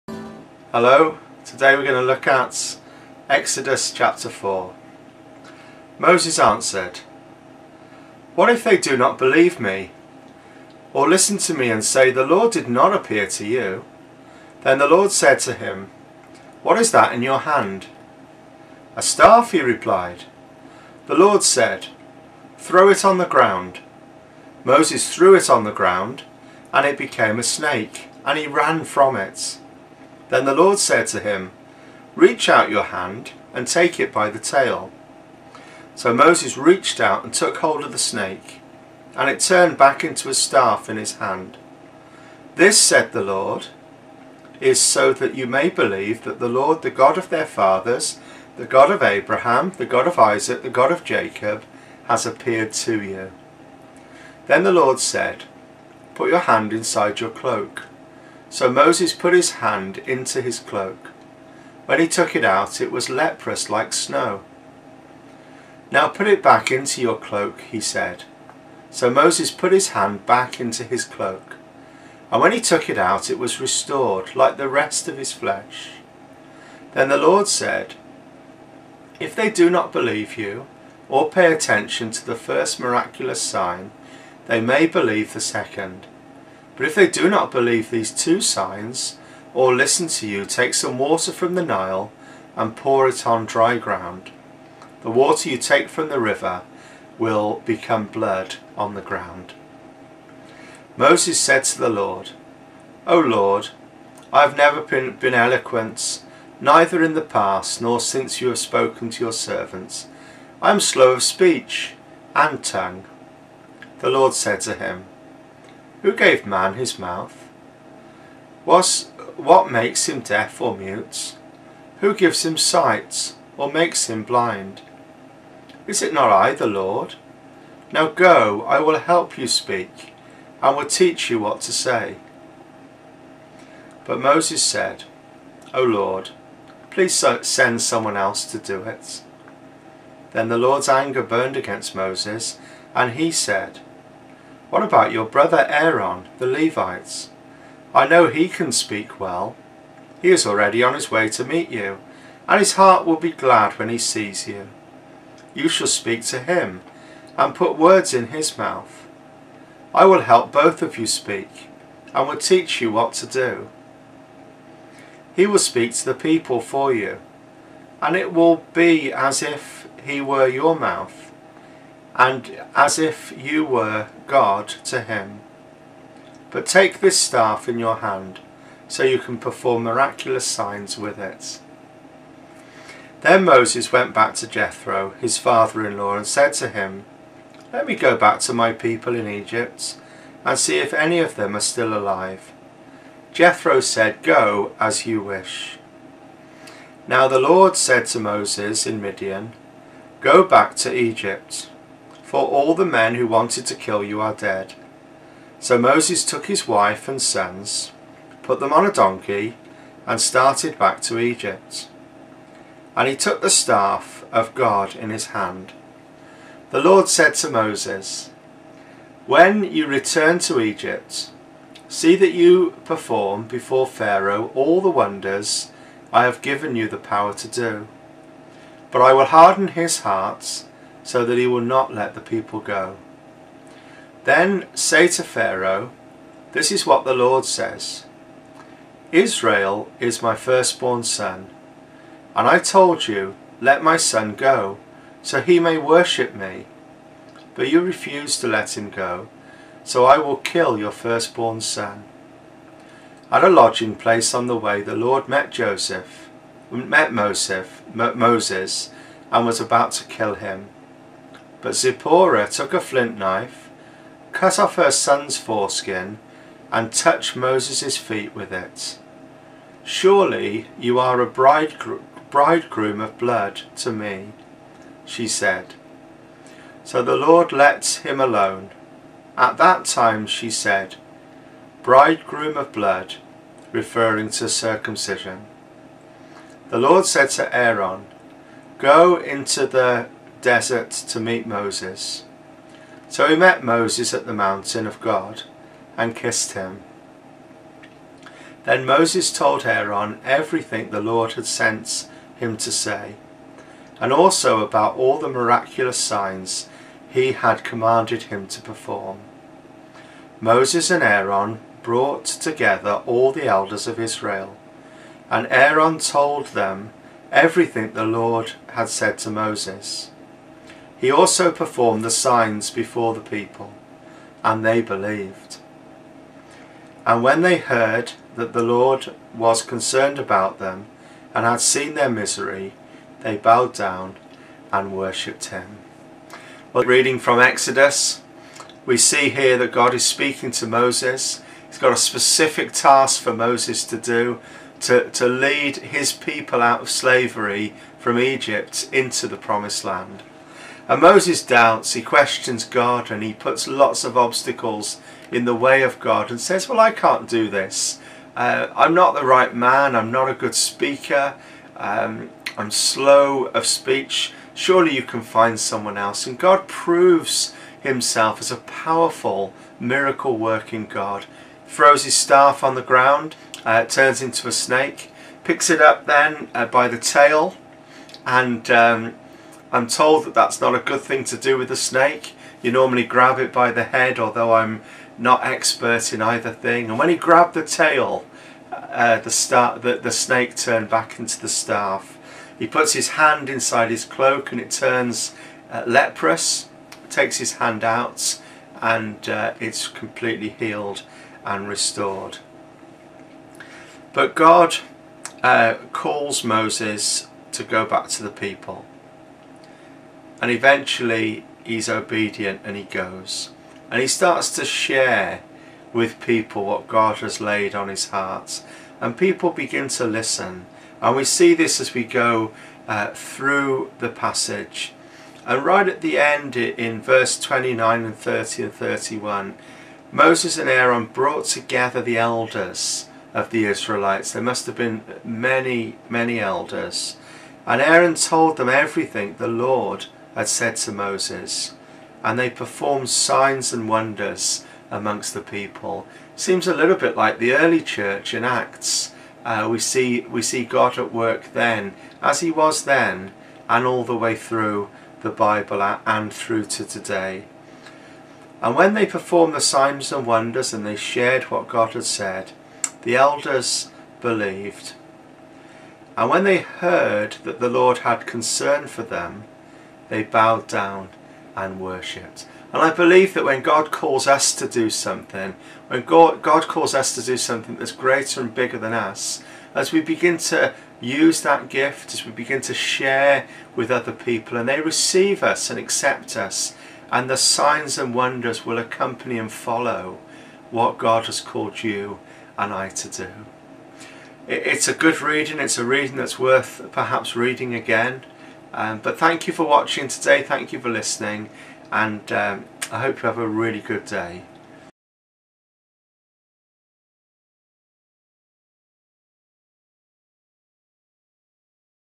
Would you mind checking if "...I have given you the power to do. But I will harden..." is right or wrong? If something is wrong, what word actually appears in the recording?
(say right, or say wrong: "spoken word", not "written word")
right.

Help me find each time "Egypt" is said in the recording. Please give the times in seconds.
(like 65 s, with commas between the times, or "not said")
189 s, 200 s, 211 s, 220 s, 348 s.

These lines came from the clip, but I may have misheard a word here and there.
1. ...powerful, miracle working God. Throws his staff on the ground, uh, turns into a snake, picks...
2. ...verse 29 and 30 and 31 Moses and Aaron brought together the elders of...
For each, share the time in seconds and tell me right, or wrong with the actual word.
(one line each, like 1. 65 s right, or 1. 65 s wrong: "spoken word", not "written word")
1. 368 s right
2. 427 s right.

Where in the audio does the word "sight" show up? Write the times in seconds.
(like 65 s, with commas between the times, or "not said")
122 s.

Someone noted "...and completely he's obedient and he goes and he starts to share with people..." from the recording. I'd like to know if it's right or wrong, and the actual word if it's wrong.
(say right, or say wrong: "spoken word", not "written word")
wrong: "eventually", not "completely".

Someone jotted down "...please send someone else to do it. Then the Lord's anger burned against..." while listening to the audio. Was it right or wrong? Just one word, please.
right.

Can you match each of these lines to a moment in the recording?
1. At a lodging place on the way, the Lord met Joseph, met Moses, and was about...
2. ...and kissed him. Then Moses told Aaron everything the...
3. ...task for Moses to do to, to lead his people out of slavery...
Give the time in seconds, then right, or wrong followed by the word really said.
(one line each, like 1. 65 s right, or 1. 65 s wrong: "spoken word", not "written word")
1. 253 s right
2. 295 s right
3. 342 s right.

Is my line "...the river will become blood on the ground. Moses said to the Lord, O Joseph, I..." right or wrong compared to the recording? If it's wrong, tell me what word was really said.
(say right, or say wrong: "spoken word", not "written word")
wrong: "Lord", not "Joseph".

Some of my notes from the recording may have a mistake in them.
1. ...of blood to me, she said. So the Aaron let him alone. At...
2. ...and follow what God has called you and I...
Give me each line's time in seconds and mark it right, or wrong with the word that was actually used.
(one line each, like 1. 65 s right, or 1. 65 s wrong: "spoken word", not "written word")
1. 273 s wrong: "Lord", not "Aaron"
2. 489 s right.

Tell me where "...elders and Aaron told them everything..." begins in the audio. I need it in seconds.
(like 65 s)
436 s.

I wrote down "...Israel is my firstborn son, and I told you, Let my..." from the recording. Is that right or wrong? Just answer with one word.
right.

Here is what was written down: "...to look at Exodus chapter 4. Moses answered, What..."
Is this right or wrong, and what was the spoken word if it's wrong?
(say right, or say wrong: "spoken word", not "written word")
right.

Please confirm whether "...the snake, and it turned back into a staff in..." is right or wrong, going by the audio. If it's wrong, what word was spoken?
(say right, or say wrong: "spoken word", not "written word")
right.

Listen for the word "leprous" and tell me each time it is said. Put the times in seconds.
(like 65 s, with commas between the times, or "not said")
63 s, 395 s.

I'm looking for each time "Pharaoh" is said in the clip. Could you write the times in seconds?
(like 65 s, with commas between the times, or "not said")
223 s, 235 s.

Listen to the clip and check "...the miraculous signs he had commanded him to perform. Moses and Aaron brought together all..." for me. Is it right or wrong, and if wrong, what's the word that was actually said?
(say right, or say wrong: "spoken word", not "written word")
right.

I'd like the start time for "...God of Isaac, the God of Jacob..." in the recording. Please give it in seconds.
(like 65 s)
49 s.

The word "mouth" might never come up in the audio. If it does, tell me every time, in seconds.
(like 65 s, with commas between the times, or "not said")
116 s, 158 s, 170 s.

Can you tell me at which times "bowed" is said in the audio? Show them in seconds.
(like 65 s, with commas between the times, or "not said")
333 s, 470 s.